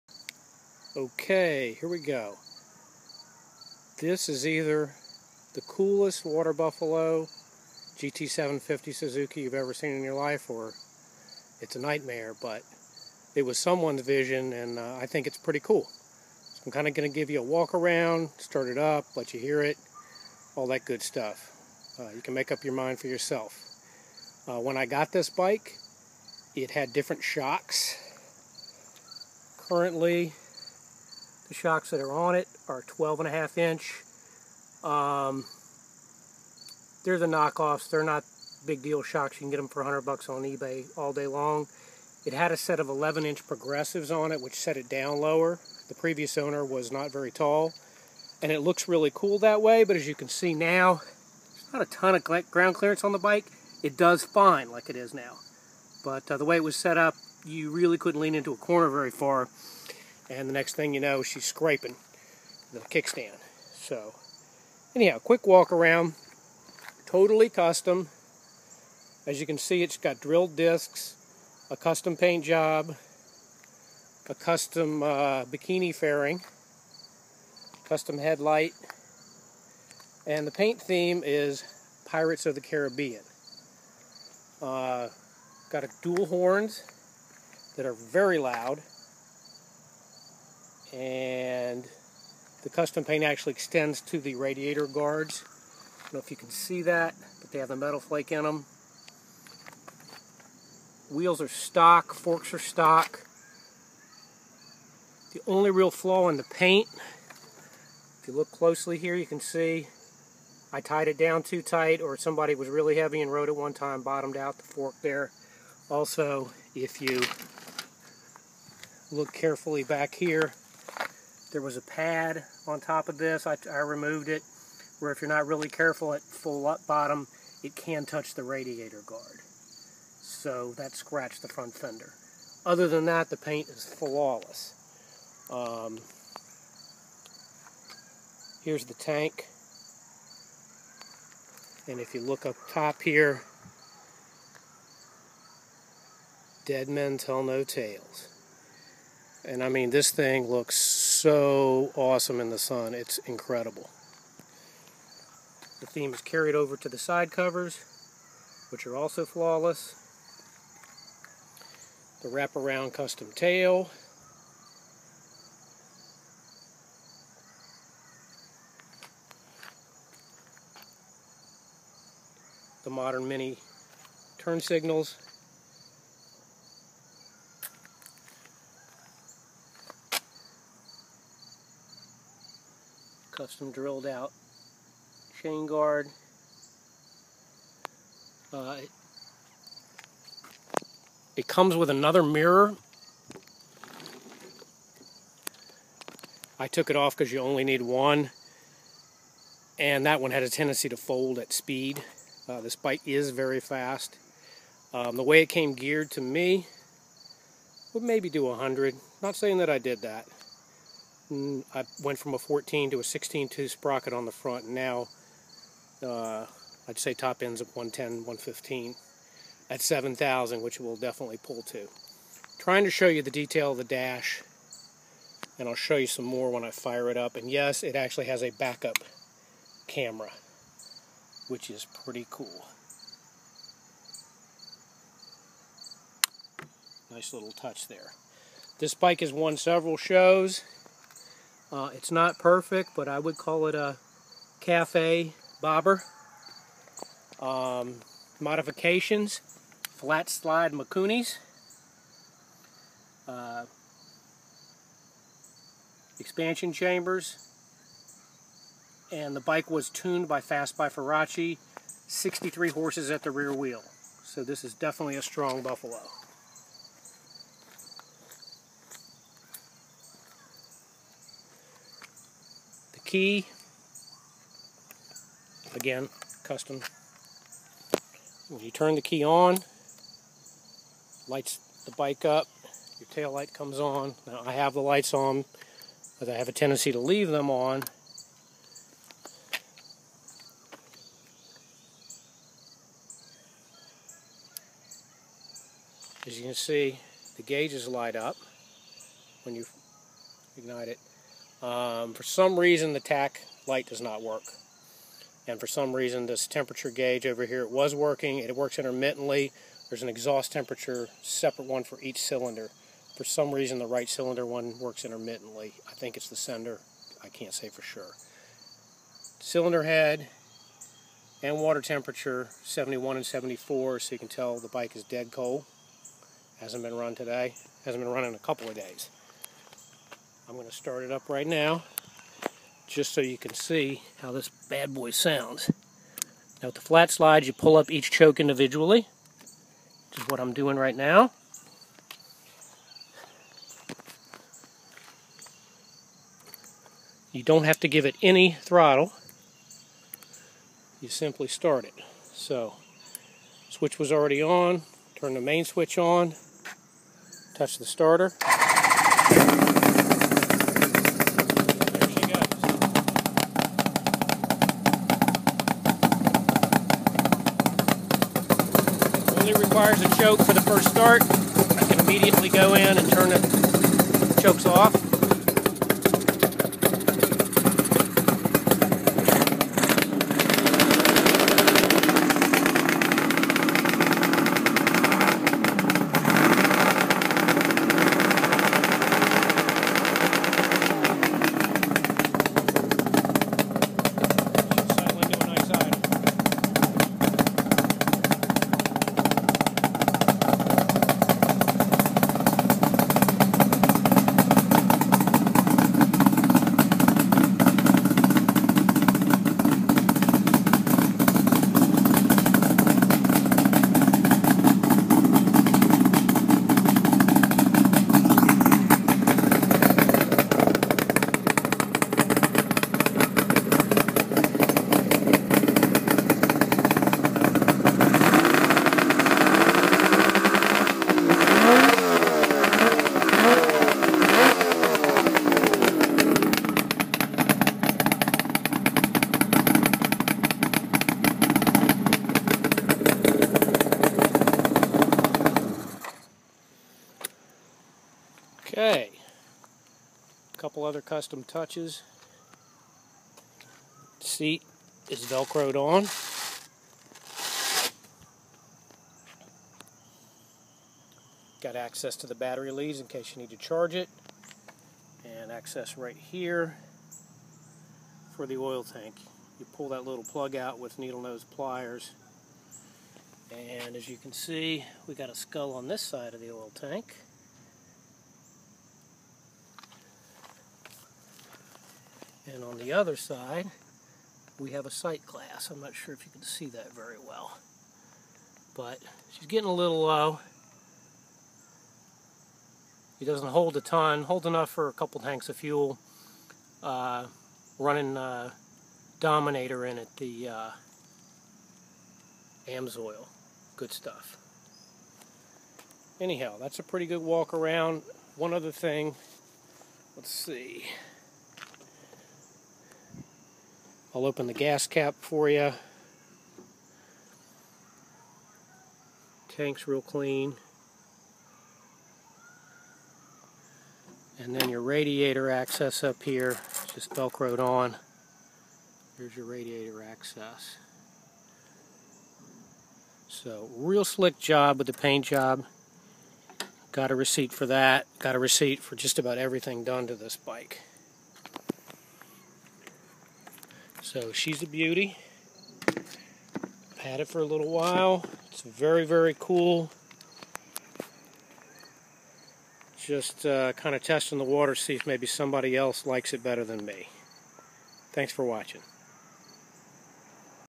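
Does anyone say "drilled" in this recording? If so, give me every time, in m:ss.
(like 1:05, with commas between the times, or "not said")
1:10, 3:03.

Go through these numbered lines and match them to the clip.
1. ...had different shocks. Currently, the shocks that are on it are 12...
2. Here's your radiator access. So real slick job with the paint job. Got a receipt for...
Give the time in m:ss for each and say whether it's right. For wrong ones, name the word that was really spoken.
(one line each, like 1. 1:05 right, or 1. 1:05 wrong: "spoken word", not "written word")
1. 0:26 right
2. 8:49 right.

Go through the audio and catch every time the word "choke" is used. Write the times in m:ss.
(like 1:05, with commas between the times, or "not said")
5:38, 6:10, 6:14.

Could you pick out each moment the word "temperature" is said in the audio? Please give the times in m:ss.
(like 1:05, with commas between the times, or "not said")
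5:06, 5:10, 5:21.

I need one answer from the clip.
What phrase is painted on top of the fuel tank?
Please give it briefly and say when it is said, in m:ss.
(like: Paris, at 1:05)
Dead men tell no tales, at 2:26.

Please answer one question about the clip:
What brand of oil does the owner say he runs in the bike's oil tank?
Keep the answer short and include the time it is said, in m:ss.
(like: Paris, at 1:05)
Amsoil, at 8:22.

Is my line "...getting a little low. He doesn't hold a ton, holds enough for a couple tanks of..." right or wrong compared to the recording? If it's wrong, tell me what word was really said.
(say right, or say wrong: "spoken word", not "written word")
right.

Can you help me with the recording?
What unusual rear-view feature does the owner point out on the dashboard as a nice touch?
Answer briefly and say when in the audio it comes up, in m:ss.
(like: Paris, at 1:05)
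Backup camera, at 3:48.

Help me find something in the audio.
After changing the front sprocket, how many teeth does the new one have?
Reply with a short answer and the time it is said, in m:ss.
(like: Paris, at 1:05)
16, at 3:33.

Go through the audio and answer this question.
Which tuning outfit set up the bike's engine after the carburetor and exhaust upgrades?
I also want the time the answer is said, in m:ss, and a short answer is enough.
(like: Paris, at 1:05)
Fast by Ferracci, at 4:20.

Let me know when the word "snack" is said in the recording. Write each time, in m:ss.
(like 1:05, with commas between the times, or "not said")
not said.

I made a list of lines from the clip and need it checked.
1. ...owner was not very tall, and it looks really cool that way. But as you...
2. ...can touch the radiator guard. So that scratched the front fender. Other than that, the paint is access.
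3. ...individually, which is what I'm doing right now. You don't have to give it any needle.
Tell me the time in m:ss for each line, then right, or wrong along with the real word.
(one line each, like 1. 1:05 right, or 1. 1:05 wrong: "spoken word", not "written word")
1. 0:46 right
2. 2:07 wrong: "flawless", not "access"
3. 5:38 wrong: "throttle", not "needle".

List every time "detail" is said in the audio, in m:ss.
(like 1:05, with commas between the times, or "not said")
3:43.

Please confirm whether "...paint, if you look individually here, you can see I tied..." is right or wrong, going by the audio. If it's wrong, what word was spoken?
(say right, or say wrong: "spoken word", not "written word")
wrong: "closely", not "individually".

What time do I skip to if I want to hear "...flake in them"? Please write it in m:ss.
1:37.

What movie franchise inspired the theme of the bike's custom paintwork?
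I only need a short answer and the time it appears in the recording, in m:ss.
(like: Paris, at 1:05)
Pirates of the Caribbean, at 1:22.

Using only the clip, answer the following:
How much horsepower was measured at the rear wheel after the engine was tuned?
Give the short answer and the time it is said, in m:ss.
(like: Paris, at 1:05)
63, at 4:22.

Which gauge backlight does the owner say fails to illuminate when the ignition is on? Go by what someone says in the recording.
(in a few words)
Tach light.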